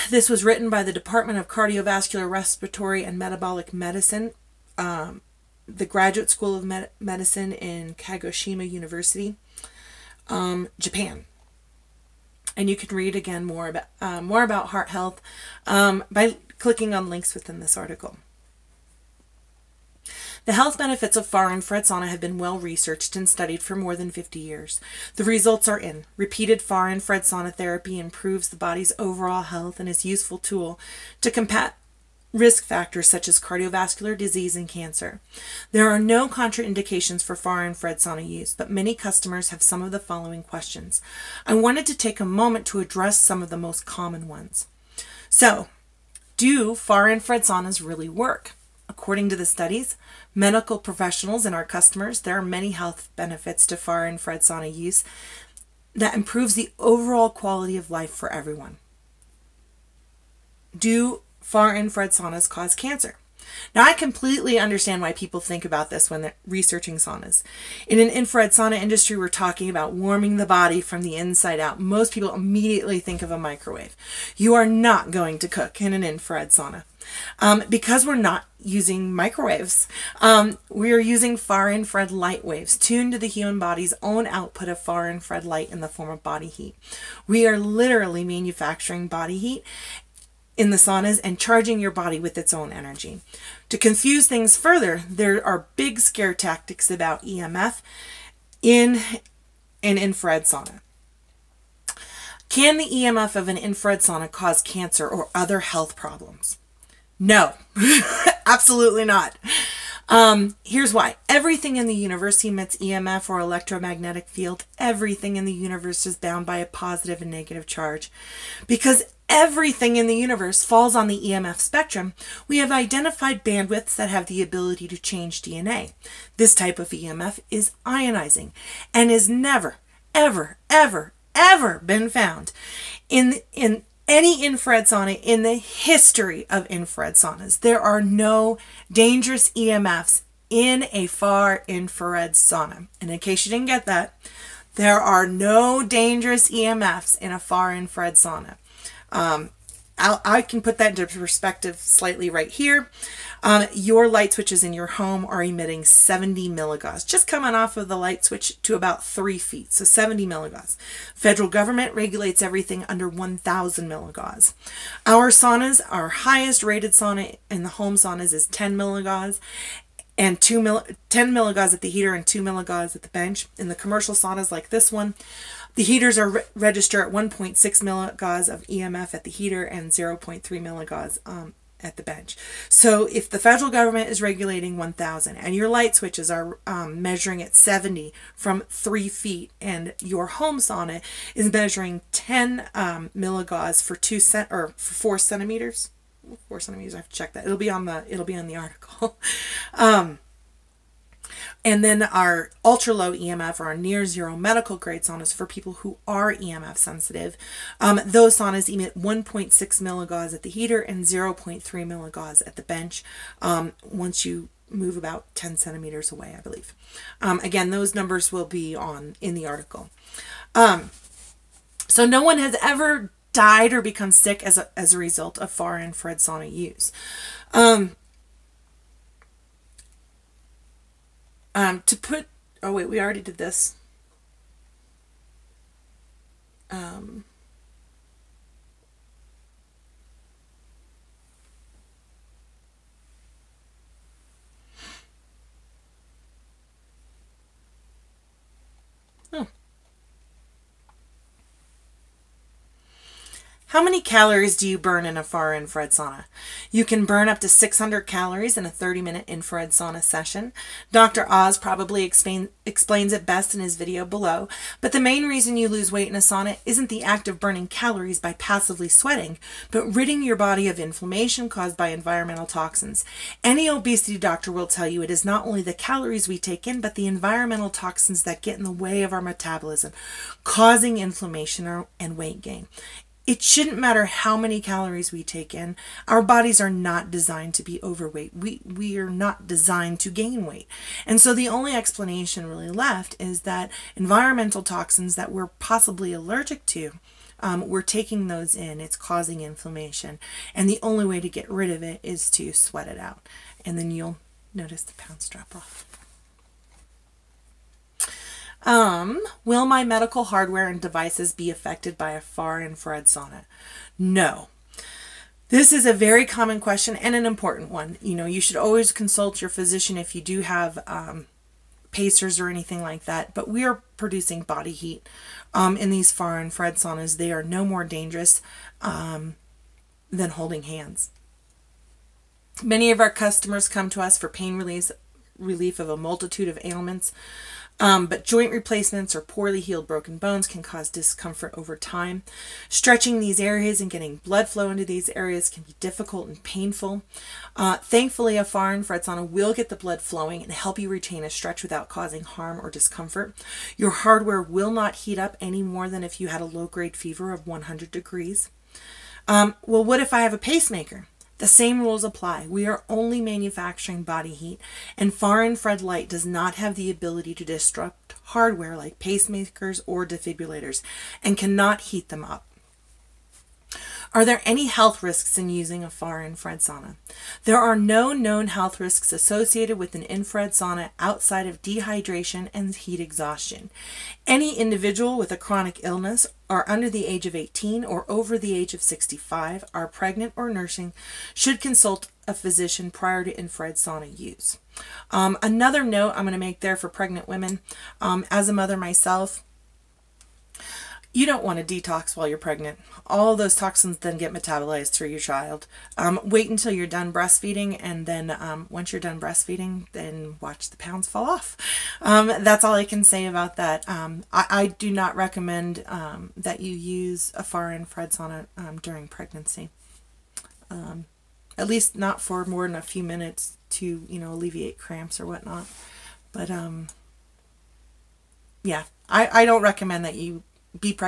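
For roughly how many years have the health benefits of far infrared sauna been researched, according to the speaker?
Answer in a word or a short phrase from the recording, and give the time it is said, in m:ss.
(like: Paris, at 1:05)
more than 50 years, at 0:23.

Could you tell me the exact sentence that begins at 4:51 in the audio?
And so the only explanation really left is that environmental toxins that we're possibly allergic to, um, we're taking those in.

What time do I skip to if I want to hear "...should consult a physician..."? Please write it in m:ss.
6:31.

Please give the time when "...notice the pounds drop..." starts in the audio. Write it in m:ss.
5:04.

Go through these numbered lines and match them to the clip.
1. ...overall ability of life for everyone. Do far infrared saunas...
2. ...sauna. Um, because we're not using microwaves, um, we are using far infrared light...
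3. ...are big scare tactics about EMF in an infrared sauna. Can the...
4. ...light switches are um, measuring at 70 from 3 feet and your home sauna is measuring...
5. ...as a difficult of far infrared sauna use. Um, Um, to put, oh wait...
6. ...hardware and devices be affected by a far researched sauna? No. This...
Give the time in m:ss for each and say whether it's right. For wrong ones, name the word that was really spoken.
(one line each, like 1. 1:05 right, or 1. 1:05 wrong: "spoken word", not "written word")
1. 0:56 wrong: "quality", not "ability"
2. 1:16 right
3. 1:35 right
4. 3:05 right
5. 3:44 wrong: "result", not "difficult"
6. 5:10 wrong: "infrared", not "researched".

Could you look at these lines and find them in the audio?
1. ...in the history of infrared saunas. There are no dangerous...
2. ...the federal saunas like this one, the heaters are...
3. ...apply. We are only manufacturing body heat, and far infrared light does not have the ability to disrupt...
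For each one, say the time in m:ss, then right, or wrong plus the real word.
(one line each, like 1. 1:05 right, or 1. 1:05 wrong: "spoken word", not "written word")
1. 2:15 right
2. 2:53 wrong: "commercial", not "federal"
3. 6:02 right.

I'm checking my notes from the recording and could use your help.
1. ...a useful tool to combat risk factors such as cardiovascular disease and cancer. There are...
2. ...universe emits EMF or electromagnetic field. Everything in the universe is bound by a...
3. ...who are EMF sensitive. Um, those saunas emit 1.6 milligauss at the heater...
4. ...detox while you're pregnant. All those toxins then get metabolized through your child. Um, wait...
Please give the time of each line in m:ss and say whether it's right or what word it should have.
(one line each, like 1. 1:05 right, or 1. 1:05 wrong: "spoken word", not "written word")
1. 0:30 right
2. 1:51 right
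3. 3:25 right
4. 6:41 right.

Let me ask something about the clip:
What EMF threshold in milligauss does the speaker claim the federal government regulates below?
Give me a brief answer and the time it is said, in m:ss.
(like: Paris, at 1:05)
1,000 milligauss, at 2:43.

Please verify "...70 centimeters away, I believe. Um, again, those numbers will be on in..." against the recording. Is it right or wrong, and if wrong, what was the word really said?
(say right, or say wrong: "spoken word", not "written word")
wrong: "10", not "70".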